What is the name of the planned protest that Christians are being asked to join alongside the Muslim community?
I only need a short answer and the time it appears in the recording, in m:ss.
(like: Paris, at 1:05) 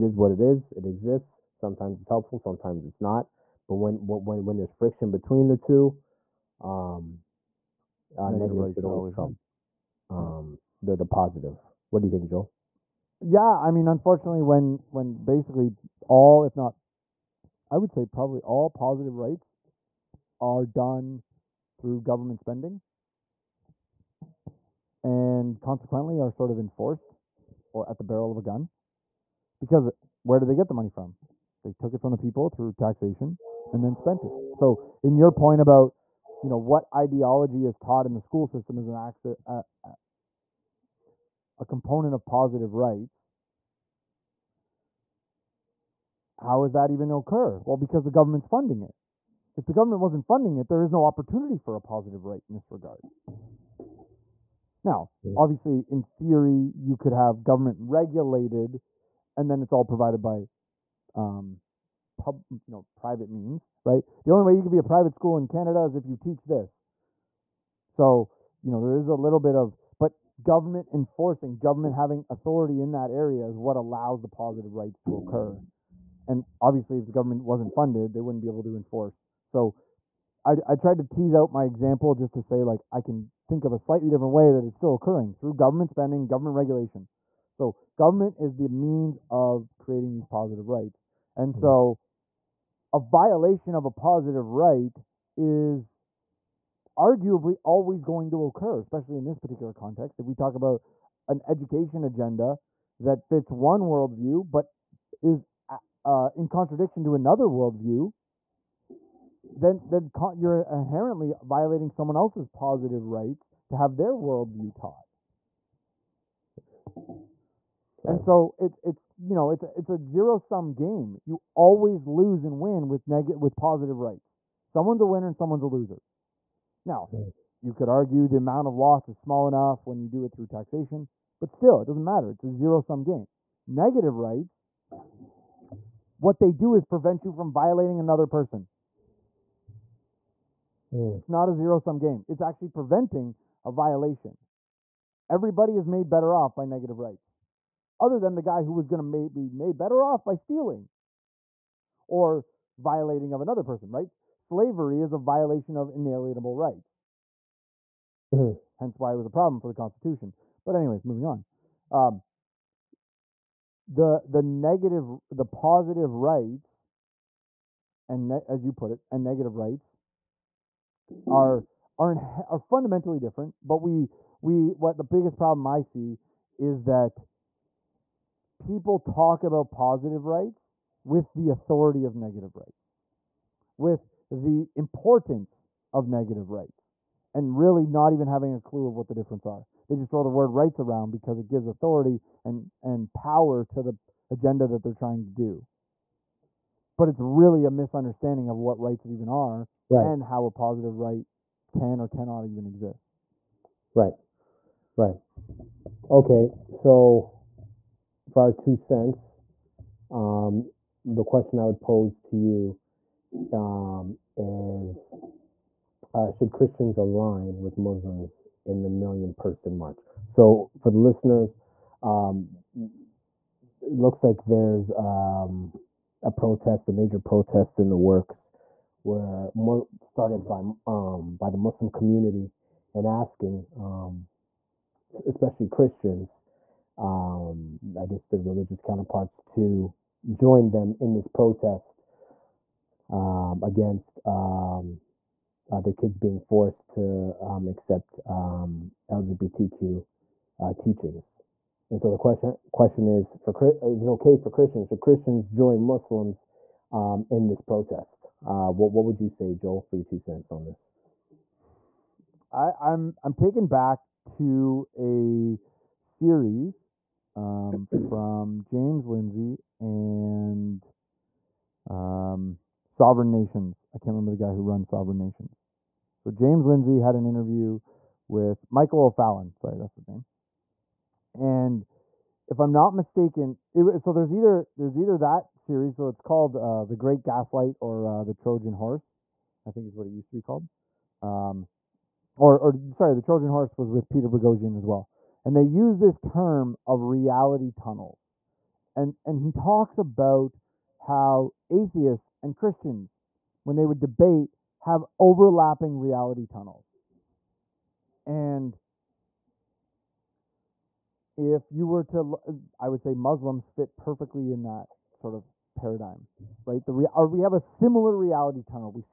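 Million Person March, at 3:38.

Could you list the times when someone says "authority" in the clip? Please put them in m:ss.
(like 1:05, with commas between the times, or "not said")
1:12, 3:01, 3:11.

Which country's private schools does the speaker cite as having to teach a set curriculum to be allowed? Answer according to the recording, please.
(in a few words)
Canada.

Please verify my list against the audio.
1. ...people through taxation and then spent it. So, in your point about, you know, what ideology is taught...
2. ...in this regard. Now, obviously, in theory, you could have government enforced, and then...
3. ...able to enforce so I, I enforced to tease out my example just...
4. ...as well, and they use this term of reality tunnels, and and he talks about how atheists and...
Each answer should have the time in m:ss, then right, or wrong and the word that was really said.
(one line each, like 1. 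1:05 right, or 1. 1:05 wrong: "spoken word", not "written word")
1. 0:32 right
2. 0:52 wrong: "regulated", not "enforced"
3. 1:18 wrong: "tried", not "enforced"
4. 4:54 right.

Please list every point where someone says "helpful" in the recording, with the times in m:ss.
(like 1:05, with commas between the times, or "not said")
0:02.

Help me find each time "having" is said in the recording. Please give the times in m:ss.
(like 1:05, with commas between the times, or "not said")
1:11, 3:08.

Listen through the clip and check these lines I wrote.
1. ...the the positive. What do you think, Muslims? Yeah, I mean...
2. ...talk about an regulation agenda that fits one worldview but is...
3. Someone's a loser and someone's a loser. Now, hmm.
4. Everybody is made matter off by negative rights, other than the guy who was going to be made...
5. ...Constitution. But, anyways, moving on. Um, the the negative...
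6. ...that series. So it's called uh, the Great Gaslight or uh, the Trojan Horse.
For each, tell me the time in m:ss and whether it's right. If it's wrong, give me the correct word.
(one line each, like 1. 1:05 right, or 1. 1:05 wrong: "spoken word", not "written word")
1. 0:10 wrong: "Joel", not "Muslims"
2. 1:40 wrong: "education", not "regulation"
3. 2:04 wrong: "winner", not "loser"
4. 2:25 wrong: "better", not "matter"
5. 2:39 right
6. 4:45 right.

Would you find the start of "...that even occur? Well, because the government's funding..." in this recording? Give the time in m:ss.
0:46.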